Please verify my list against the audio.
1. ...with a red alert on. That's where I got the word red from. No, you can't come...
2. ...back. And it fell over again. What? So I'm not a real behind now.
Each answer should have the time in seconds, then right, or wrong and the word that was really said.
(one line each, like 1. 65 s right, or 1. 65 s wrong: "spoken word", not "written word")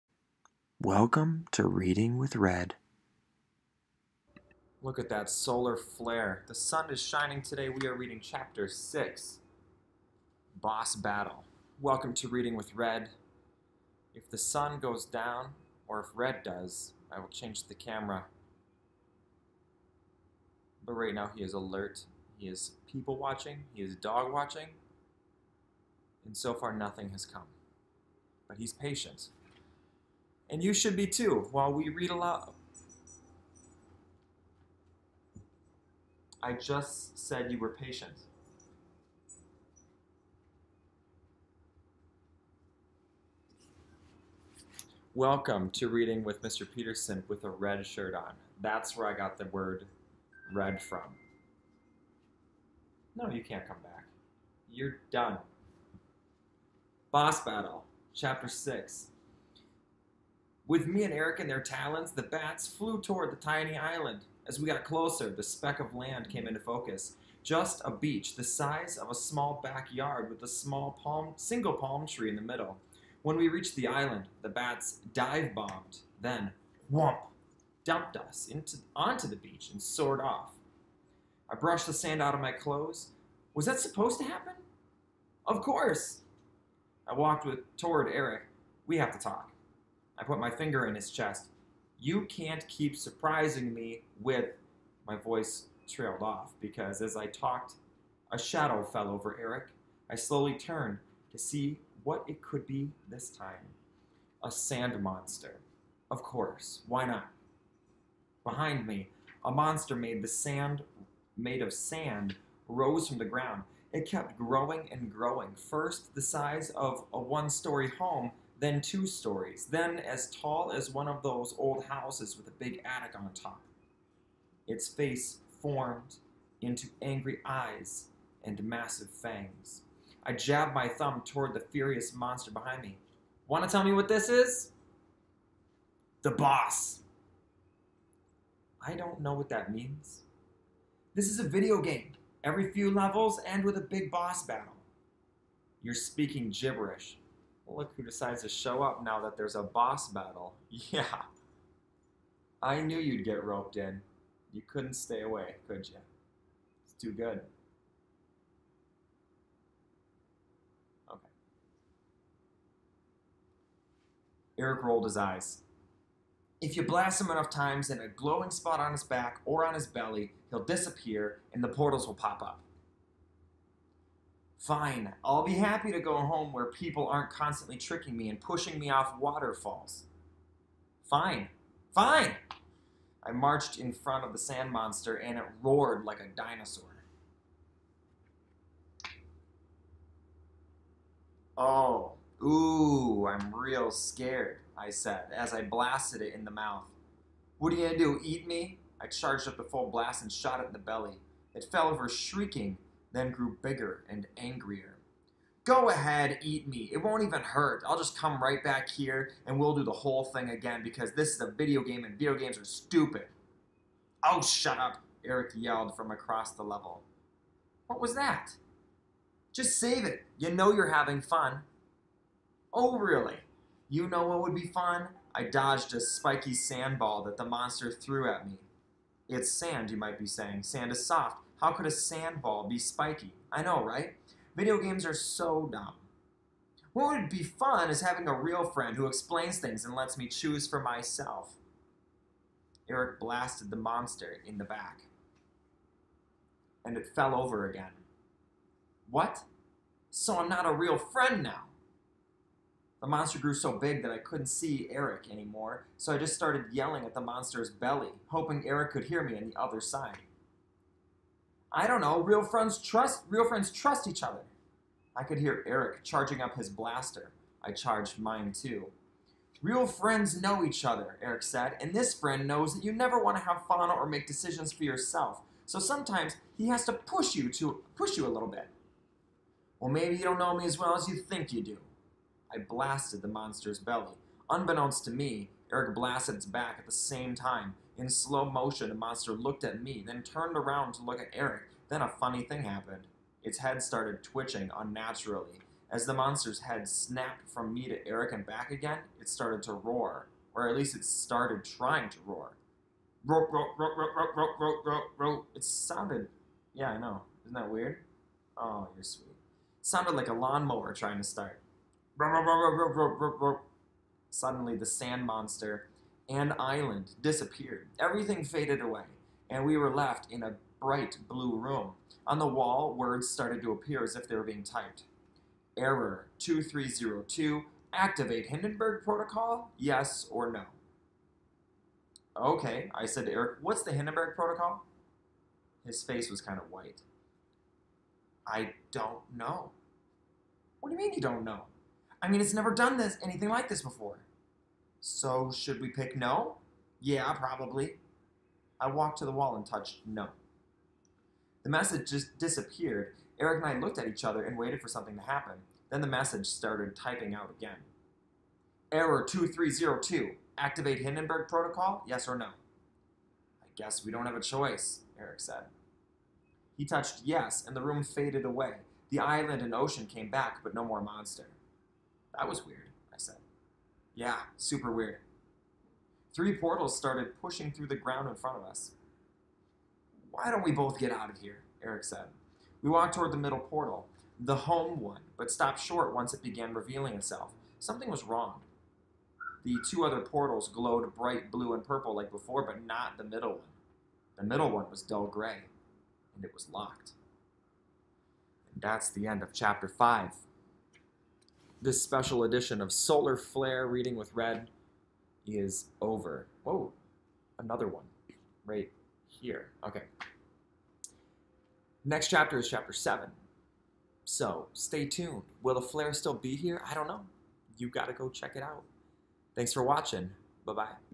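1. 47 s wrong: "shirt", not "alert"
2. 244 s wrong: "friend", not "behind".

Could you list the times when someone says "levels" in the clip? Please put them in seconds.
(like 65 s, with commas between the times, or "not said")
142 s, 216 s.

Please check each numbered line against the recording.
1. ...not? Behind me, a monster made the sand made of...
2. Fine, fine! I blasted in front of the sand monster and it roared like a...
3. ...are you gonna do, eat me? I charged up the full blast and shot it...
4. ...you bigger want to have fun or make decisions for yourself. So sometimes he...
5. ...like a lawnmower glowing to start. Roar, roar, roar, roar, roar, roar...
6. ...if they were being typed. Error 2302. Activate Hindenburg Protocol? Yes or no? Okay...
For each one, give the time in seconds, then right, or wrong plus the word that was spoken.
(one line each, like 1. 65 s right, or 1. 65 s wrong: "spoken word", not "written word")
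1. 107 s right
2. 181 s wrong: "marched", not "blasted"
3. 197 s right
4. 272 s wrong: "never", not "bigger"
5. 310 s wrong: "trying", not "glowing"
6. 324 s right.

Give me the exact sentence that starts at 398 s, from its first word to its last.
And that's the end of chapter 5 this special edition of Solar Flare Reading with Red is over.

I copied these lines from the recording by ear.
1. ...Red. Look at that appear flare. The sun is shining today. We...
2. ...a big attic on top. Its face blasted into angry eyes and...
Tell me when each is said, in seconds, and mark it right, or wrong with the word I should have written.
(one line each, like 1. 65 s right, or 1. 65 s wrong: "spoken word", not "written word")
1. 2 s wrong: "solar", not "appear"
2. 122 s wrong: "formed", not "blasted".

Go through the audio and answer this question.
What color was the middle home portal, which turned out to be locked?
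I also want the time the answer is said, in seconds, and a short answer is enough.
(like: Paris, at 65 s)
dull gray, at 395 s.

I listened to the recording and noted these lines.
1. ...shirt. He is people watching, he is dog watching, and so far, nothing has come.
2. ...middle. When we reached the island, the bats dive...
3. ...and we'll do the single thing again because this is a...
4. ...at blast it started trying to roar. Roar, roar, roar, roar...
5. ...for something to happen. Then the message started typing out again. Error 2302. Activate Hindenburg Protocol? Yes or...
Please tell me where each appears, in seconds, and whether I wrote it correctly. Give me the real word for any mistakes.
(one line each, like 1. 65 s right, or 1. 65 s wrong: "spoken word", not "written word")
1. 21 s wrong: "alert", not "shirt"
2. 72 s right
3. 209 s wrong: "whole", not "single"
4. 300 s wrong: "least", not "blast"
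5. 354 s right.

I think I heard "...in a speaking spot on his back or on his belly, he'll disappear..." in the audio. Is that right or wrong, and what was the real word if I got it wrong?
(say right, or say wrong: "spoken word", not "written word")
wrong: "glowing", not "speaking".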